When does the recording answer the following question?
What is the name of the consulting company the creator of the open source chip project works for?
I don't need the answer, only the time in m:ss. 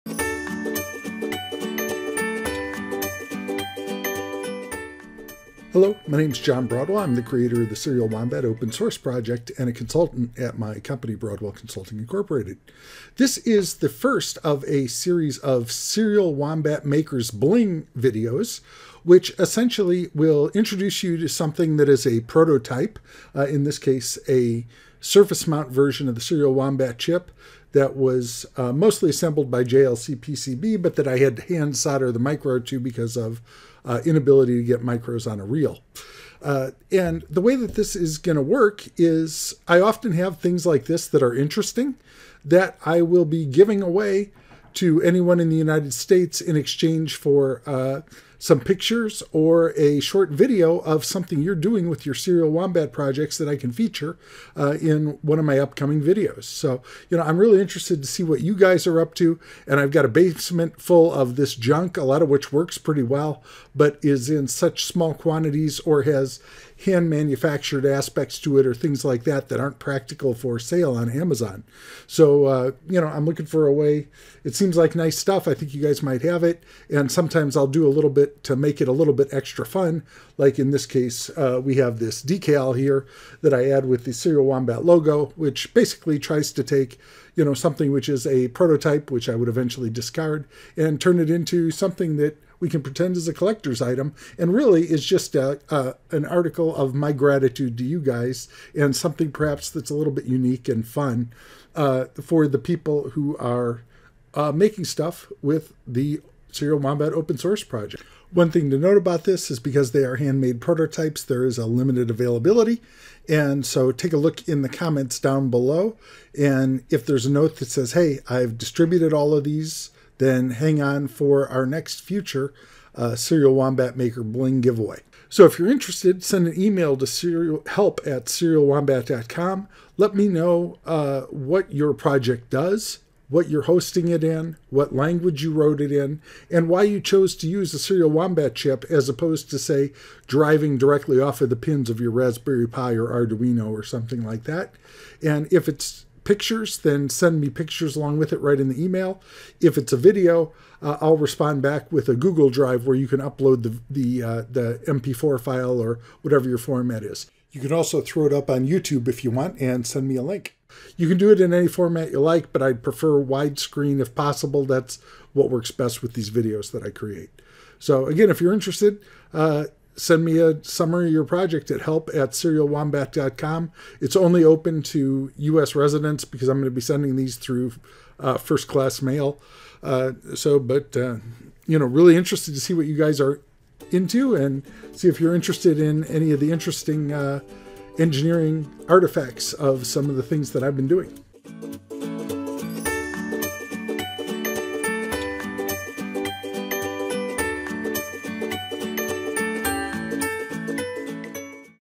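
0:11.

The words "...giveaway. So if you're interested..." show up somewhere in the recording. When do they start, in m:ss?
2:04.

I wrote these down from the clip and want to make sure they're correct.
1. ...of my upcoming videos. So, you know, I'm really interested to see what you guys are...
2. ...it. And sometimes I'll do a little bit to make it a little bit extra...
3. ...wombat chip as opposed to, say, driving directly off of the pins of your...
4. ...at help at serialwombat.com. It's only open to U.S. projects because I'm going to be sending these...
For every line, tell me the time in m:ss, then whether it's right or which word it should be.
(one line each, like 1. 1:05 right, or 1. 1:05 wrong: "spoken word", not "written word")
1. 0:55 right
2. 1:16 right
3. 2:18 right
4. 2:51 wrong: "residents", not "projects".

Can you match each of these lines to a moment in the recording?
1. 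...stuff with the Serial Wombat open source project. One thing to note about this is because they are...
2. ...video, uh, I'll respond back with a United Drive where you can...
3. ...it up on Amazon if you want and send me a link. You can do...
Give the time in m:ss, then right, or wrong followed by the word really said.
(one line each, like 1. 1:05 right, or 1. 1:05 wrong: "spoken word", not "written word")
1. 1:44 right
2. 2:29 wrong: "Google", not "United"
3. 2:38 wrong: "YouTube", not "Amazon".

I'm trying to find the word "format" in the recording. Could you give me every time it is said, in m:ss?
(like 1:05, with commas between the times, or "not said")
2:36, 2:41.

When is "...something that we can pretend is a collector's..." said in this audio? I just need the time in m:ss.
1:31.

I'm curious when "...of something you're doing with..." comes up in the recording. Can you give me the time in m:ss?
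0:50.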